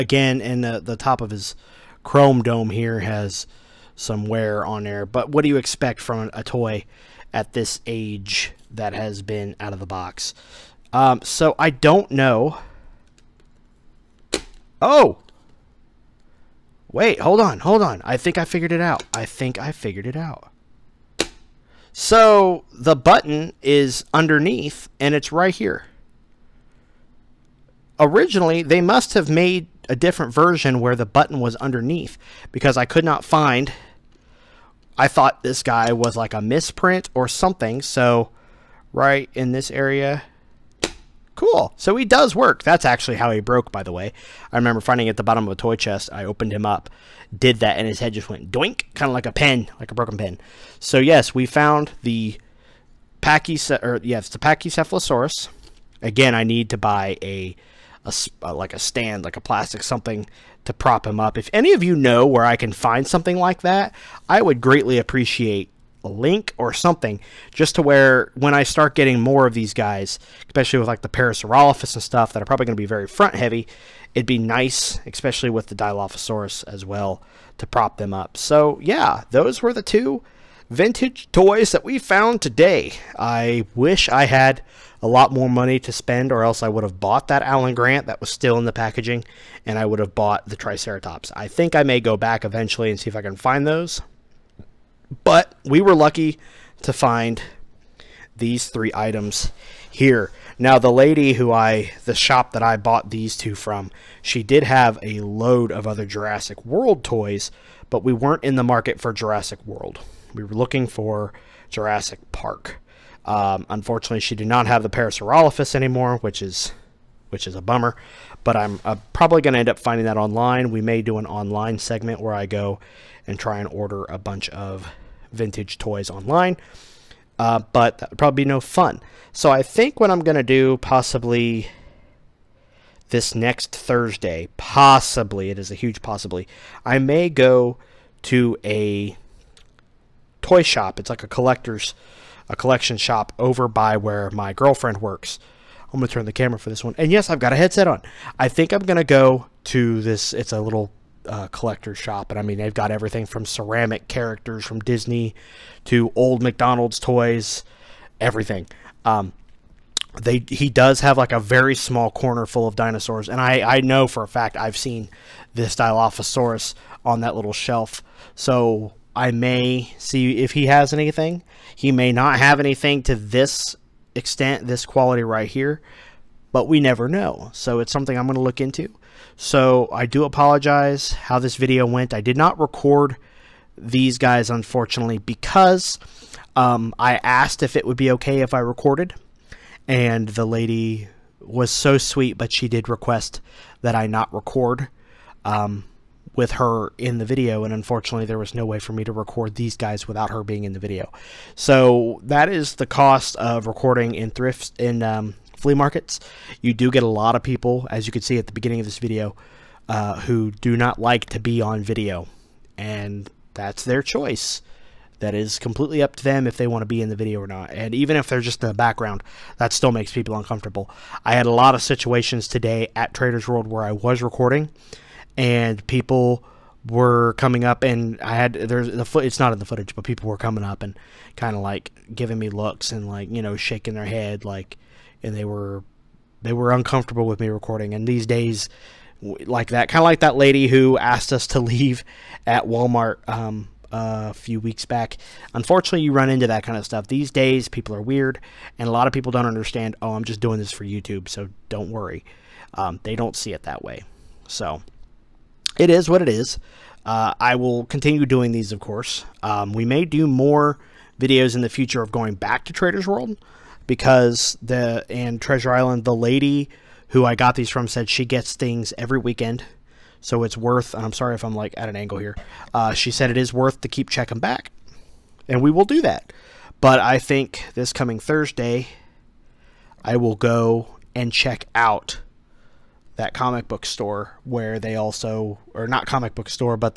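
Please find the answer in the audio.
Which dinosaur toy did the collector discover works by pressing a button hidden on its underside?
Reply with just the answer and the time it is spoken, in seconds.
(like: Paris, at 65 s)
Pachycephalosaurus, at 54 s.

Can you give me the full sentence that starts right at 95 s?
But we were lucky to find these three items here.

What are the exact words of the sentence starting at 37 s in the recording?
So right in this area, Cool.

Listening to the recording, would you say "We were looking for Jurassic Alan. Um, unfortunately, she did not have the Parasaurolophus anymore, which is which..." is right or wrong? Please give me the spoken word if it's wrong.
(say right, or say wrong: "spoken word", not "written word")
wrong: "Park", not "Alan".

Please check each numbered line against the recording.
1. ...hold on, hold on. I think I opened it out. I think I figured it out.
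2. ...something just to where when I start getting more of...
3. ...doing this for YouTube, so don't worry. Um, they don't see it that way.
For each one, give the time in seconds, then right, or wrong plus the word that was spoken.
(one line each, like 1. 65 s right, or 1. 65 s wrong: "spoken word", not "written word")
1. 17 s wrong: "figured", not "opened"
2. 66 s right
3. 250 s right.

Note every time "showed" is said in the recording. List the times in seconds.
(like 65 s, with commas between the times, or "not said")
not said.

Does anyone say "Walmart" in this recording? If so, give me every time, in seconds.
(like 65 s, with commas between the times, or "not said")
242 s.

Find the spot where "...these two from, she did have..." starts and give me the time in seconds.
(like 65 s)
103 s.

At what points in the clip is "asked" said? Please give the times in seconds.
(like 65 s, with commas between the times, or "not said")
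187 s, 240 s.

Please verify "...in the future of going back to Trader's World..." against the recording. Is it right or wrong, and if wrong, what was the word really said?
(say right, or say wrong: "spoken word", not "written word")
right.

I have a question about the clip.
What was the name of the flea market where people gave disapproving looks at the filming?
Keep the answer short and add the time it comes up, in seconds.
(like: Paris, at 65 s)
Traders World, at 223 s.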